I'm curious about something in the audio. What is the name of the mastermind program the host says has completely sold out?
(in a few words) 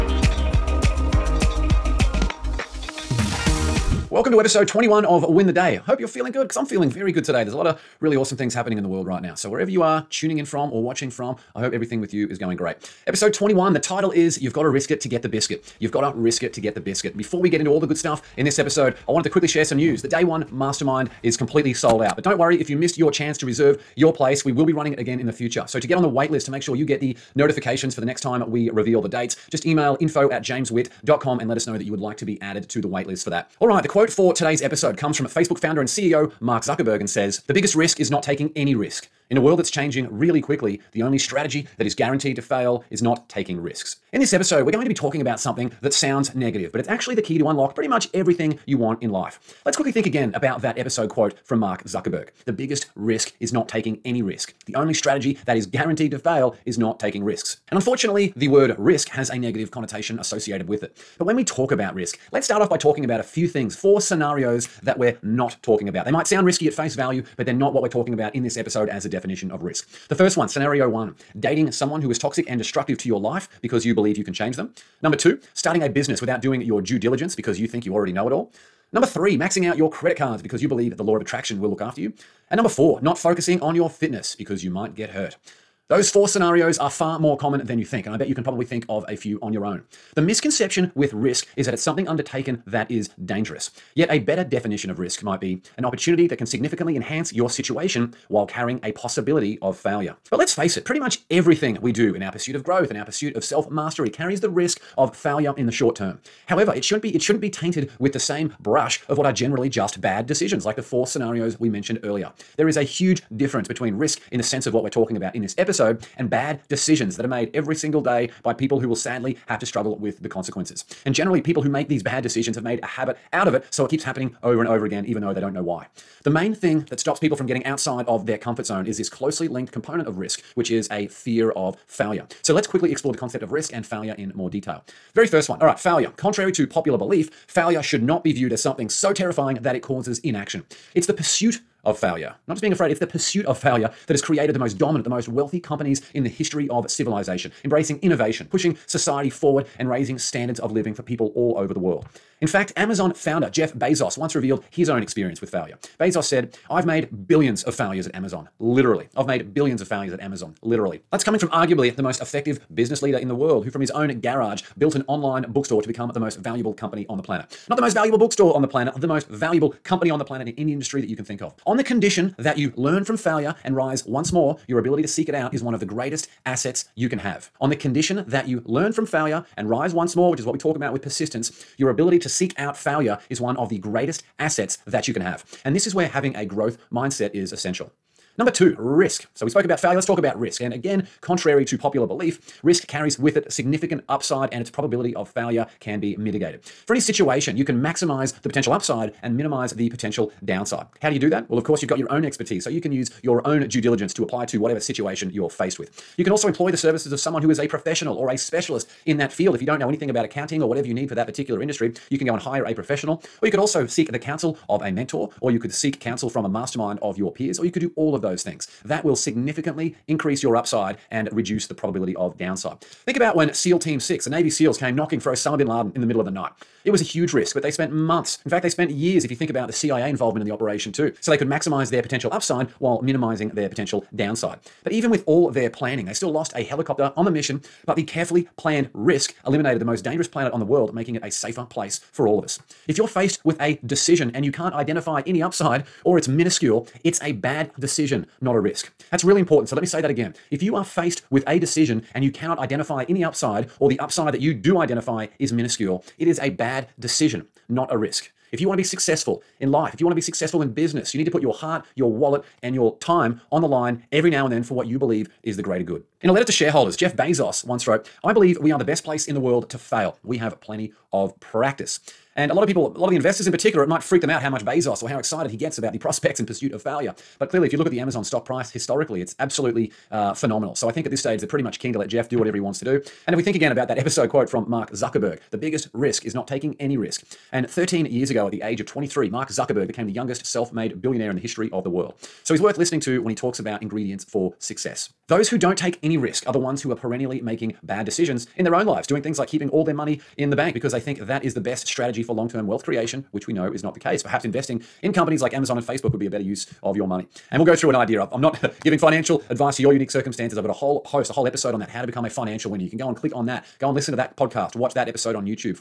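Day Won.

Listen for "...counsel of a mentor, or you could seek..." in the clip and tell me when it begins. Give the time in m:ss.
3:34.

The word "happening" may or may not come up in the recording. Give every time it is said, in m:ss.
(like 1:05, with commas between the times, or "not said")
0:08, 2:04.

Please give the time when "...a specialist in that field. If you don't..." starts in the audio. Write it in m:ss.
3:28.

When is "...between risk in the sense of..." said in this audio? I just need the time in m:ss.
1:53.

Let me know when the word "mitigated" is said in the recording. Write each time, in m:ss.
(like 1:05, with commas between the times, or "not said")
3:16.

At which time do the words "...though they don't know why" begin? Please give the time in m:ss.
2:05.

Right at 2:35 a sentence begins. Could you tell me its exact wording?
Bezos said, I've made billions of failures at Amazon, literally.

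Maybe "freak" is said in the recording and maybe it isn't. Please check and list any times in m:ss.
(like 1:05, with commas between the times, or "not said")
4:34.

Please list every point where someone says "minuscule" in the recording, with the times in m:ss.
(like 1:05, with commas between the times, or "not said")
4:06, 4:15.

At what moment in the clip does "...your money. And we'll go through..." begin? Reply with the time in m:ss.
5:06.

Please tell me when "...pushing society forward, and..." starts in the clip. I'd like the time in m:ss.
2:28.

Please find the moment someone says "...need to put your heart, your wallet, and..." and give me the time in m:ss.
4:21.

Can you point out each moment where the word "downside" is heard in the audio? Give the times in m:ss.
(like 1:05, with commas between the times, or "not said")
3:20, 3:42, 3:54.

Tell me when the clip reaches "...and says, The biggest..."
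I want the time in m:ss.
0:37.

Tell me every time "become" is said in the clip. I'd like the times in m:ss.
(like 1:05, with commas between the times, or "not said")
2:45, 5:12.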